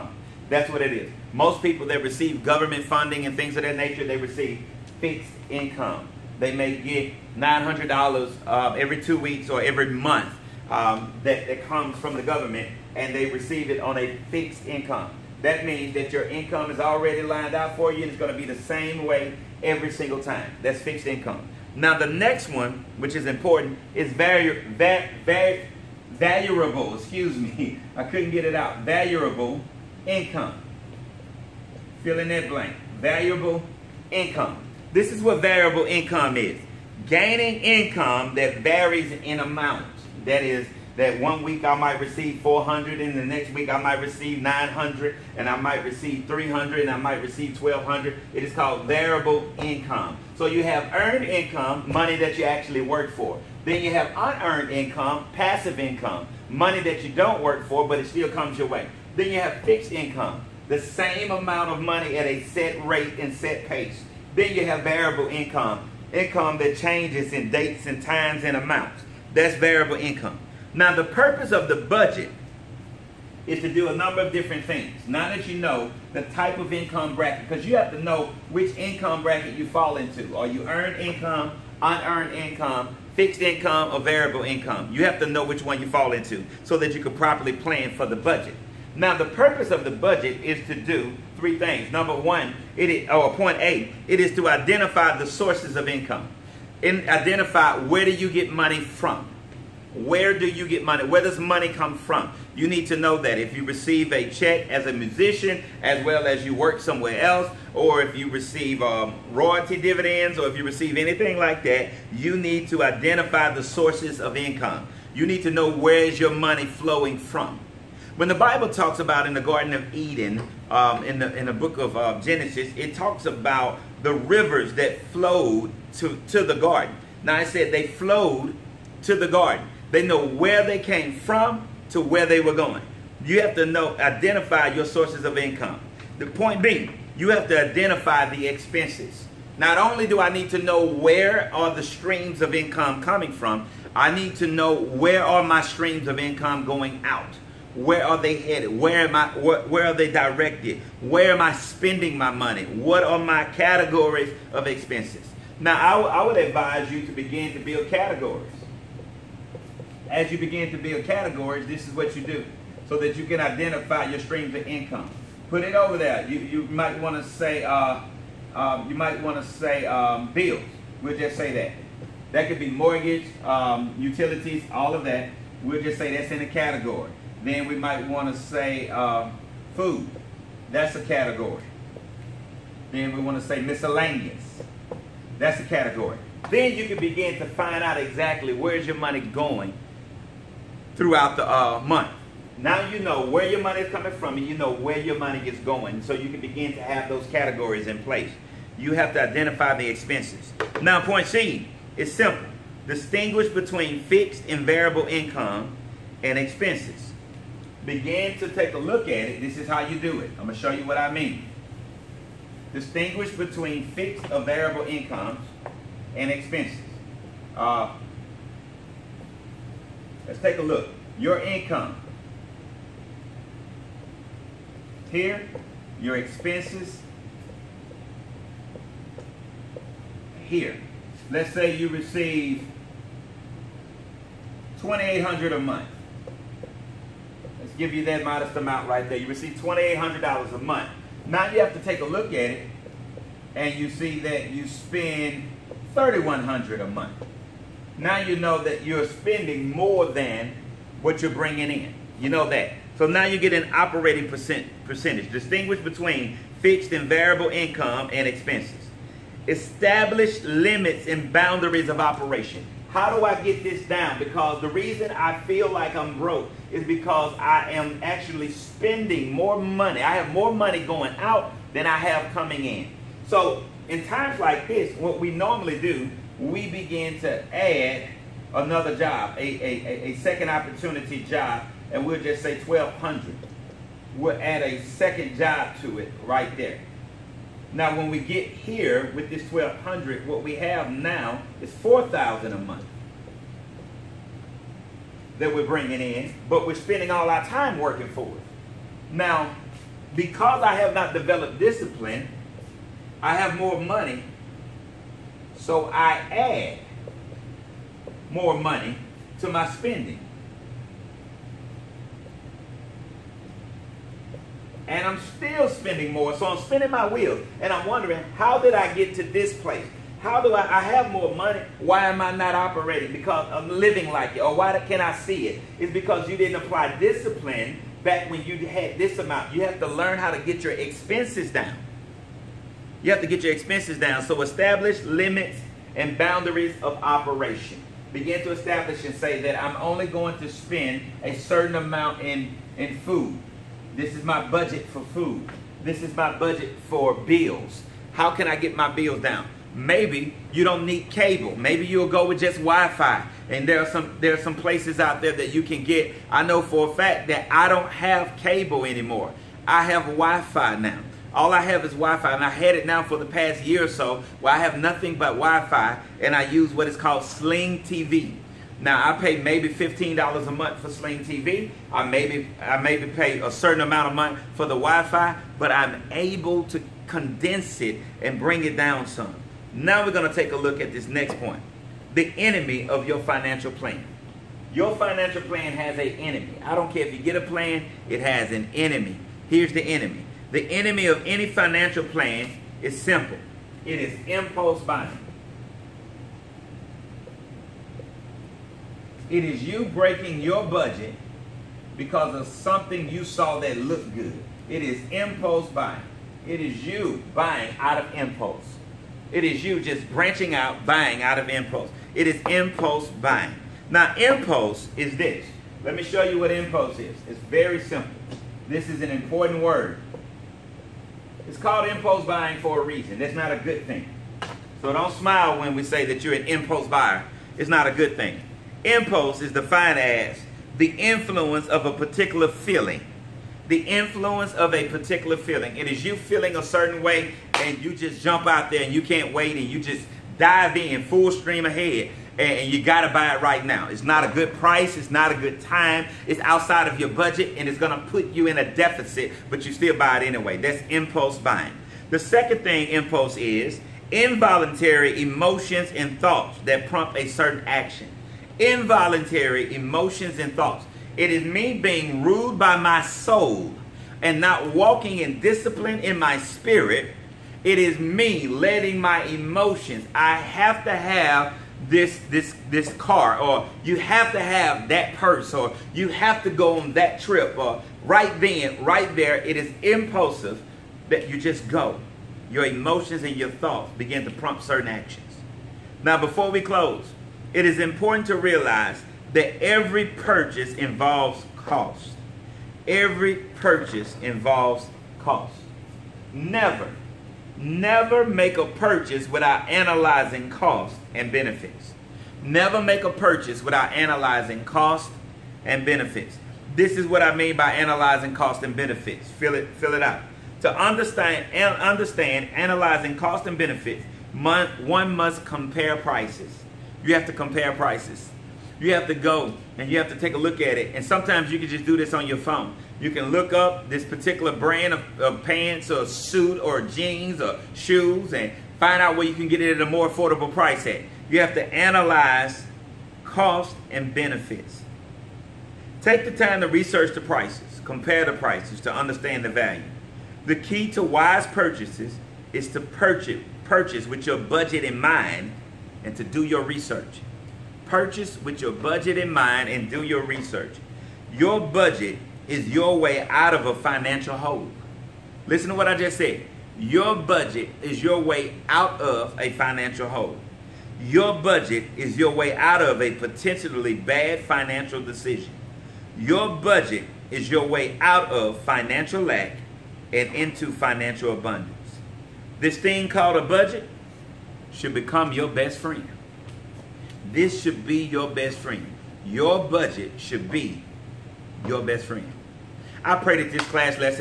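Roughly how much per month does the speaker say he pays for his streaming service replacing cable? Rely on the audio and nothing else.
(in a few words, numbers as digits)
$15.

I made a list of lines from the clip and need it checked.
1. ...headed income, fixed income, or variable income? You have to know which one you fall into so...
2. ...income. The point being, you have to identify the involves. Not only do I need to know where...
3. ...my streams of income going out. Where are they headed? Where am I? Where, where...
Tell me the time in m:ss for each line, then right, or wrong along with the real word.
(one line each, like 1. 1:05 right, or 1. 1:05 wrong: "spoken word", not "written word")
1. 1:21 wrong: "unearned", not "headed"
2. 2:15 wrong: "expenses", not "involves"
3. 2:25 right.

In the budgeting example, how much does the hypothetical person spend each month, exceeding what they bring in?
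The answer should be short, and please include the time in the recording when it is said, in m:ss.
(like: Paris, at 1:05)
3100, at 4:05.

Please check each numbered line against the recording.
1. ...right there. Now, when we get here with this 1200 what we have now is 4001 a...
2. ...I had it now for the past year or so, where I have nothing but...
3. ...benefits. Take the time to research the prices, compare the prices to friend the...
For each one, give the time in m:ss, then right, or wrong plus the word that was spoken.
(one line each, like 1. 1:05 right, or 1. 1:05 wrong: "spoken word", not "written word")
1. 4:46 wrong: "4000", not "4001"
2. 6:02 right
3. 8:54 wrong: "understand", not "friend".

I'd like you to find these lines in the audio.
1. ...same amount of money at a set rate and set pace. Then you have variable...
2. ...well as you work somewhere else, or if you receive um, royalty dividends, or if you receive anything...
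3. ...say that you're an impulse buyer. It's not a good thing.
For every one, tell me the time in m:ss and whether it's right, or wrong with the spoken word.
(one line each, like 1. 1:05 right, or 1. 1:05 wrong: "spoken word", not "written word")
1. 1:00 right
2. 1:46 right
3. 7:05 right.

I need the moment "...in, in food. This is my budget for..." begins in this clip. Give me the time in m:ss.
5:42.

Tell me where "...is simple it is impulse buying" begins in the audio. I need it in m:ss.
6:32.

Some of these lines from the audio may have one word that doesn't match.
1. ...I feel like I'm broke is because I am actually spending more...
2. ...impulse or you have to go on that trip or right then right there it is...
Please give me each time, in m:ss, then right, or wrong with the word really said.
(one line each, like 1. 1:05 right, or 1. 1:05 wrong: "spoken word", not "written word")
1. 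4:25 right
2. 7:55 wrong: "purse", not "impulse".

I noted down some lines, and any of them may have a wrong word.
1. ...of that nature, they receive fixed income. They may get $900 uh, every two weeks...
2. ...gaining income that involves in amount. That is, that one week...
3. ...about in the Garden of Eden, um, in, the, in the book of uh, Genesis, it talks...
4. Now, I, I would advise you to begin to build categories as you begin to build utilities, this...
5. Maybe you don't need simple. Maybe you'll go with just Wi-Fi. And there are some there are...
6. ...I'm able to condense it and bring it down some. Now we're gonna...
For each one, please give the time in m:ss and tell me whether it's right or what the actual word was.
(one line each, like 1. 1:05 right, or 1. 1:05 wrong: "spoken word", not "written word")
1. 0:03 right
2. 0:37 wrong: "varies", not "involves"
3. 1:58 right
4. 2:35 wrong: "categories", not "utilities"
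5. 5:49 wrong: "cable", not "simple"
6. 6:15 right.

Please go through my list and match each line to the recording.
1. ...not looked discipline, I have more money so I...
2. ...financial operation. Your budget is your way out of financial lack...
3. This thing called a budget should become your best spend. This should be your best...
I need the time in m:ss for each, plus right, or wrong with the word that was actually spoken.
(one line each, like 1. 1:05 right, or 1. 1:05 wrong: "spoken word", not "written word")
1. 5:00 wrong: "developed", not "looked"
2. 9:24 wrong: "decision", not "operation"
3. 9:32 wrong: "friend", not "spend".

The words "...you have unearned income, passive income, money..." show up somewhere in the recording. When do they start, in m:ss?
0:53.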